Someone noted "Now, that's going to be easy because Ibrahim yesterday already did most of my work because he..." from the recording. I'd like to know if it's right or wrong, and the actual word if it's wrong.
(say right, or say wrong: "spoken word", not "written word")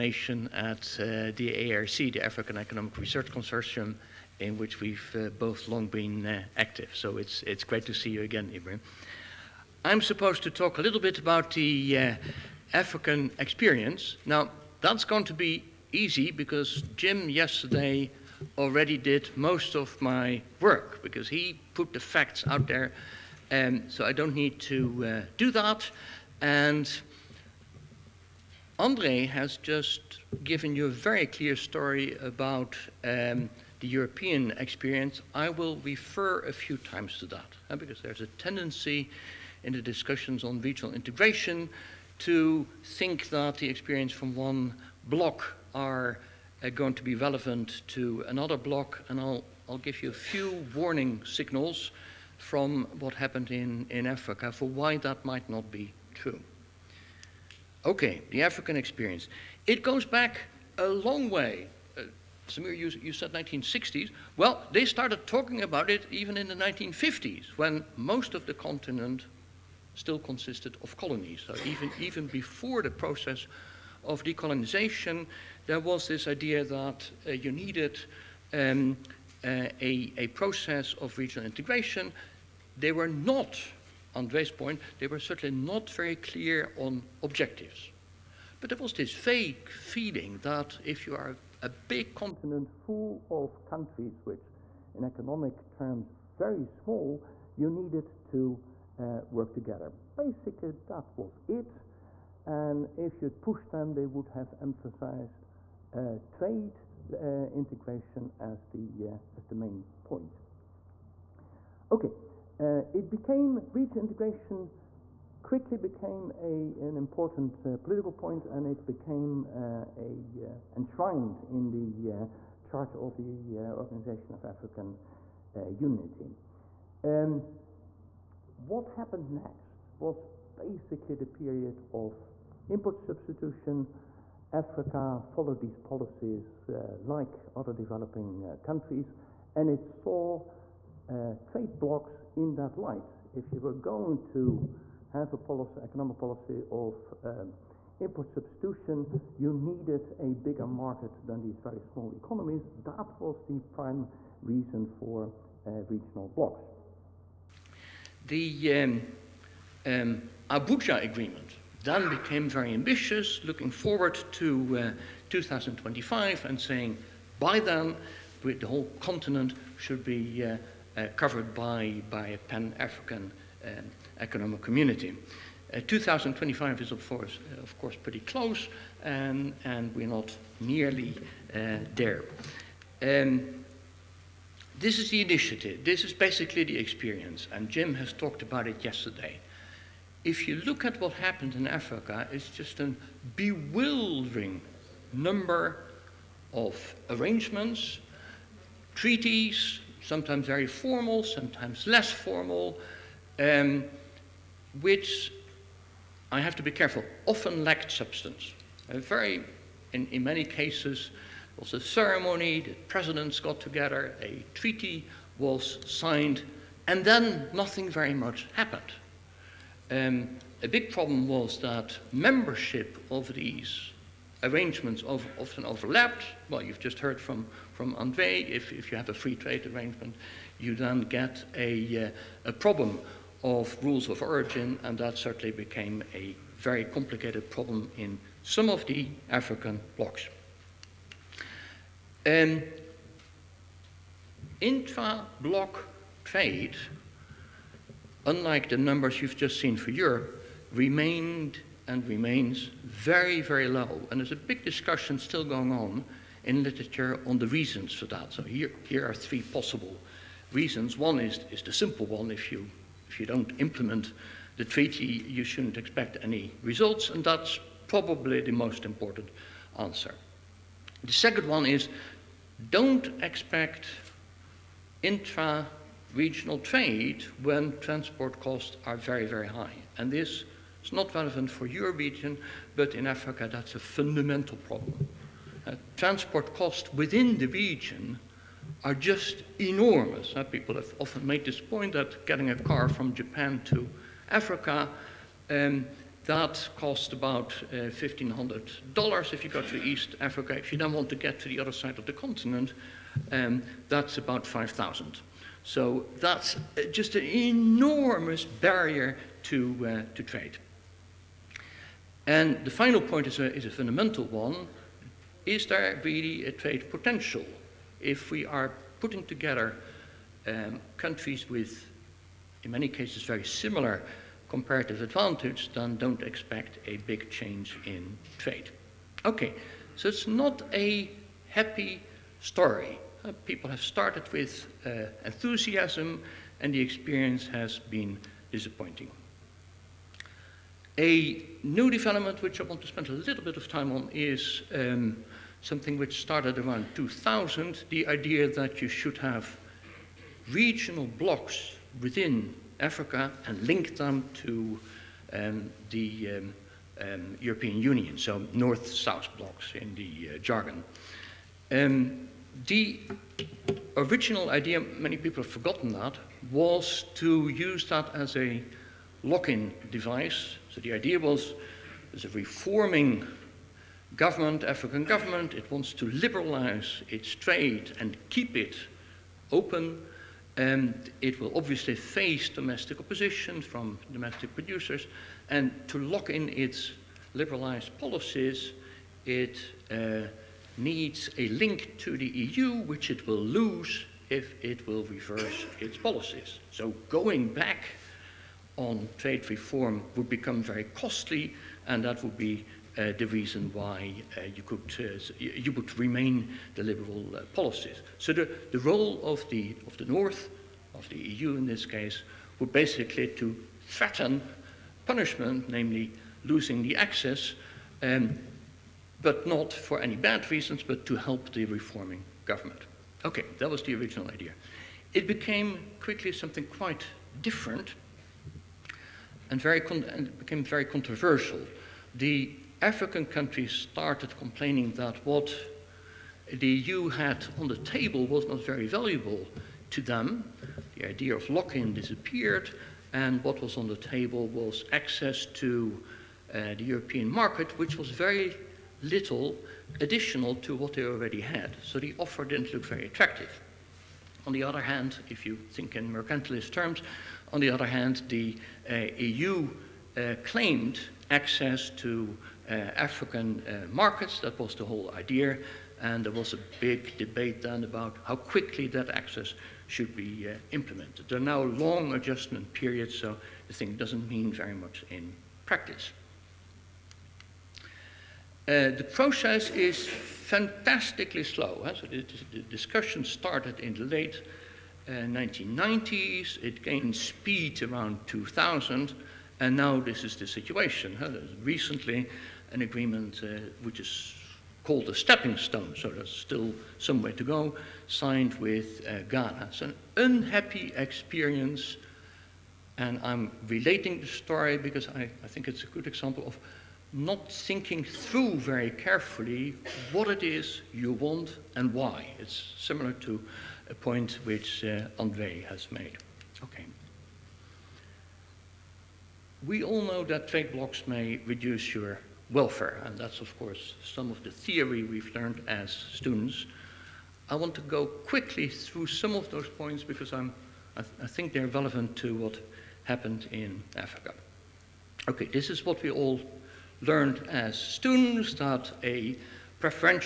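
wrong: "Jim", not "Ibrahim".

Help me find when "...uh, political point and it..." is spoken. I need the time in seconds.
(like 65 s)
117 s.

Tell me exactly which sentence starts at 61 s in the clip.
Uh, Samir, you, you said 1960s.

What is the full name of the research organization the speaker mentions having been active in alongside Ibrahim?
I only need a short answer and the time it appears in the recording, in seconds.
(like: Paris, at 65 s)
African Economic Research Consortium, at 2 s.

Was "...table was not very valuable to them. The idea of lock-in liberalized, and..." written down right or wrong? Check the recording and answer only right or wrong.
wrong.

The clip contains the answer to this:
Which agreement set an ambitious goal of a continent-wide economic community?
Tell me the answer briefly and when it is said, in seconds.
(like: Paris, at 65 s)
Abuja agreement, at 160 s.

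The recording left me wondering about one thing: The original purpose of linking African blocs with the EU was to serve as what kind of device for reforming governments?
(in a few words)
lock-in device.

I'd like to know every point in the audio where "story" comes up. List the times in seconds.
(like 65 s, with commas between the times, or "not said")
31 s, 332 s, 504 s.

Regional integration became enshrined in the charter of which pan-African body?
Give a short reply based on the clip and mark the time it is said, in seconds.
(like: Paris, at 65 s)
Organization of African Unity, at 123 s.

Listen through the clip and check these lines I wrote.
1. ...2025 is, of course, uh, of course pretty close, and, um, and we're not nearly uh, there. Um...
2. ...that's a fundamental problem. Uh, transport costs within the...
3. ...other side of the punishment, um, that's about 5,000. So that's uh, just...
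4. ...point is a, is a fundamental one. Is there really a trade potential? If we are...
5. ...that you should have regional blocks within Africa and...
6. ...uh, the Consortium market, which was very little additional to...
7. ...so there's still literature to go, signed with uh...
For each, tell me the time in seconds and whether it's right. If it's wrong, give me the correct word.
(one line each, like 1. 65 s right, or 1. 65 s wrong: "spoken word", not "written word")
1. 175 s right
2. 283 s right
3. 301 s wrong: "continent", not "punishment"
4. 313 s right
5. 348 s right
6. 446 s wrong: "European", not "Consortium"
7. 495 s wrong: "somewhere", not "literature".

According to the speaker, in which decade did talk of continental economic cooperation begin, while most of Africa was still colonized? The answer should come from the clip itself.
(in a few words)
1950s.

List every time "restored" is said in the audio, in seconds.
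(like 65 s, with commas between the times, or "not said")
not said.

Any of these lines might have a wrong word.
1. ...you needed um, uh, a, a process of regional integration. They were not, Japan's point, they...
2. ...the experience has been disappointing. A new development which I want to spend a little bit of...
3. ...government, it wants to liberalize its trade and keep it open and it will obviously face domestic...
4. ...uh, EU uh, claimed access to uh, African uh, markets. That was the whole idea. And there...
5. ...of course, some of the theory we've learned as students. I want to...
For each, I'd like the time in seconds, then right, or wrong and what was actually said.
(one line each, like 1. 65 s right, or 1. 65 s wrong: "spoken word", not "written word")
1. 77 s wrong: "Andre", not "Japan"
2. 336 s right
3. 375 s right
4. 458 s right
5. 523 s right.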